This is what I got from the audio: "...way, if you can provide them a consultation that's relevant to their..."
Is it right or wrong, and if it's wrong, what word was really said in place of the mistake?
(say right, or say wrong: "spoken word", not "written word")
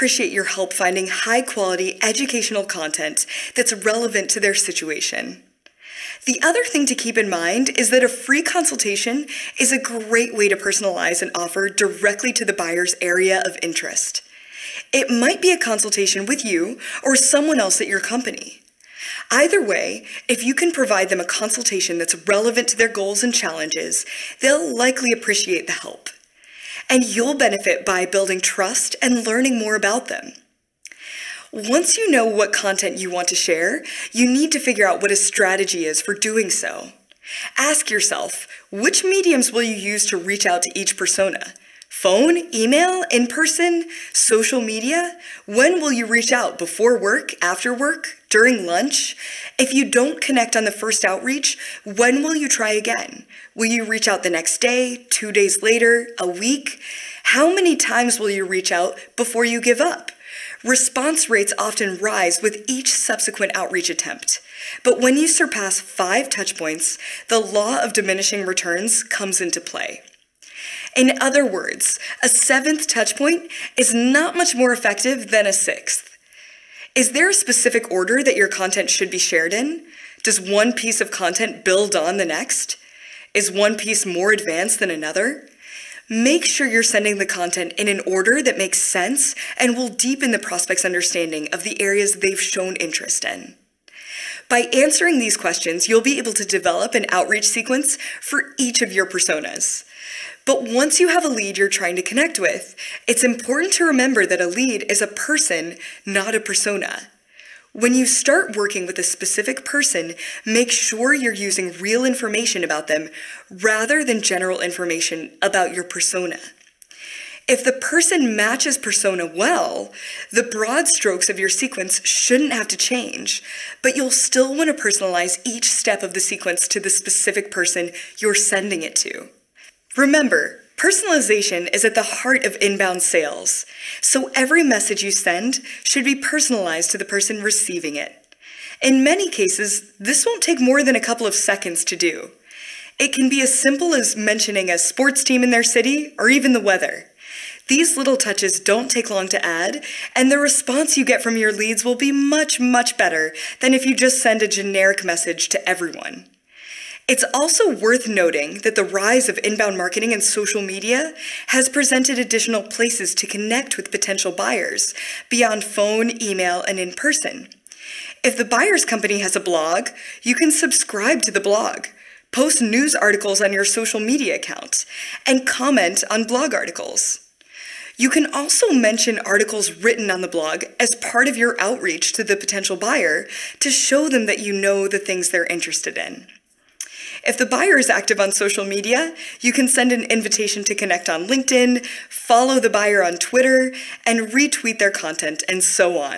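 right.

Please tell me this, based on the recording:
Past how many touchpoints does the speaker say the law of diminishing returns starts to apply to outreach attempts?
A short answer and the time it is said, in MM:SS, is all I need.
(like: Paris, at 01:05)
5, at 01:05.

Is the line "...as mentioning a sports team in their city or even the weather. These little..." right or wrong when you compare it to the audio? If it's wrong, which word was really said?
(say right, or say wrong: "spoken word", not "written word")
right.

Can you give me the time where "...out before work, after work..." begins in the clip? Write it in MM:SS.
00:46.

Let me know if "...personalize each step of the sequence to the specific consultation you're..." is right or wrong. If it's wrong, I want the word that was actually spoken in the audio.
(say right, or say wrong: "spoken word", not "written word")
wrong: "person", not "consultation".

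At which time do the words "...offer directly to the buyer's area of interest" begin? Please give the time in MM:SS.
00:11.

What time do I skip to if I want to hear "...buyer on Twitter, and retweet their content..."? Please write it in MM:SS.
03:12.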